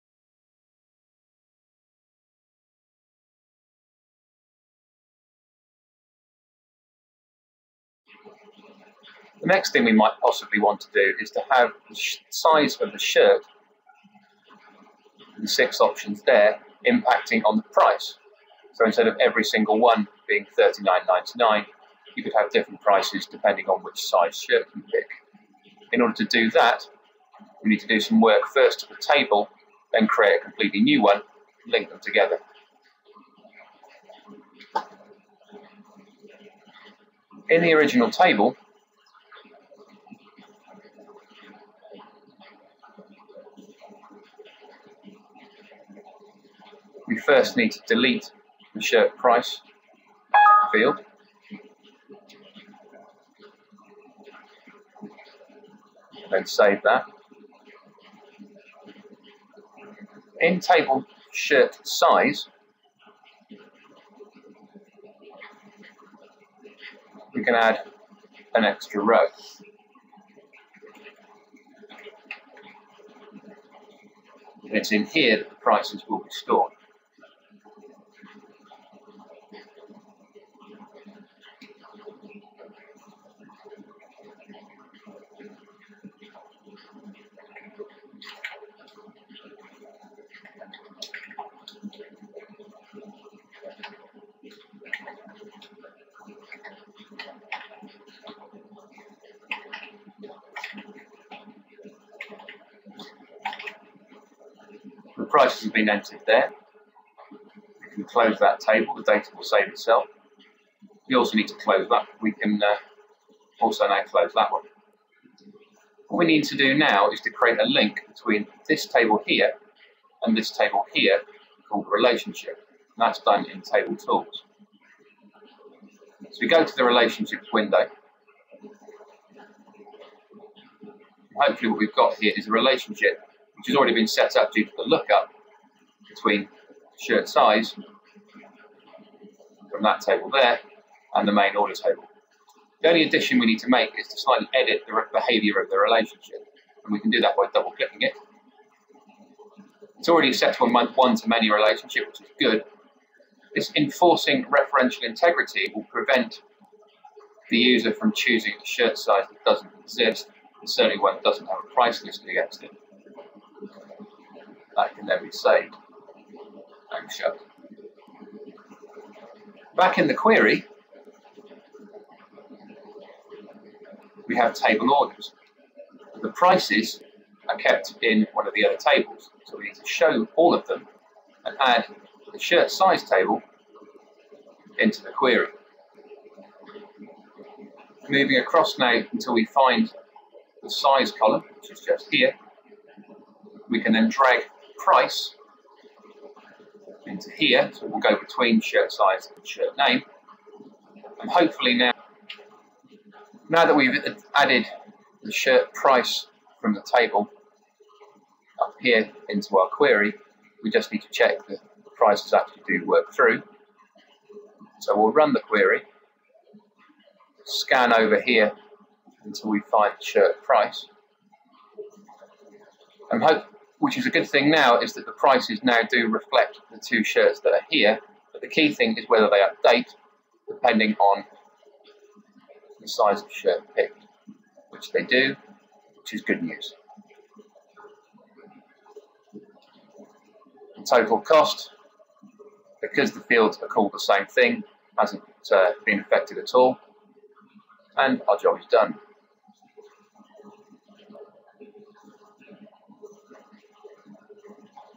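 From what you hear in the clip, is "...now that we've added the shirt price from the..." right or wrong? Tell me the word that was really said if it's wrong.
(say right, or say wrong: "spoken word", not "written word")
right.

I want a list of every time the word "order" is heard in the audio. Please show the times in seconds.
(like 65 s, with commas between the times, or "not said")
26 s, 141 s, 174 s.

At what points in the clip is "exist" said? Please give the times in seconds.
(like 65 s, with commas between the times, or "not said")
159 s.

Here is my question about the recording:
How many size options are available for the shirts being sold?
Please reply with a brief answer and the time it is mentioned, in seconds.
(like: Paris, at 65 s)
6, at 15 s.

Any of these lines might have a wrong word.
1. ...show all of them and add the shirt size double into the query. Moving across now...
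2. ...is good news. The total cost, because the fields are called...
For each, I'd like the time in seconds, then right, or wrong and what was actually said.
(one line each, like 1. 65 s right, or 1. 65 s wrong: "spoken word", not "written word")
1. 179 s wrong: "table", not "double"
2. 236 s right.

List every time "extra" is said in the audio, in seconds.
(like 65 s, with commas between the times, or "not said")
68 s.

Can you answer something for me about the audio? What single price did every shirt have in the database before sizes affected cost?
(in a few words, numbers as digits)
$39.99.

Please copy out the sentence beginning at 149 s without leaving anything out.
It's already set to a one-to-many relationship, which is good.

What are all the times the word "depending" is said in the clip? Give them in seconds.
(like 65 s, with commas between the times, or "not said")
23 s, 230 s.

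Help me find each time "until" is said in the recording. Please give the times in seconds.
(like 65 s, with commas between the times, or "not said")
189 s, 219 s.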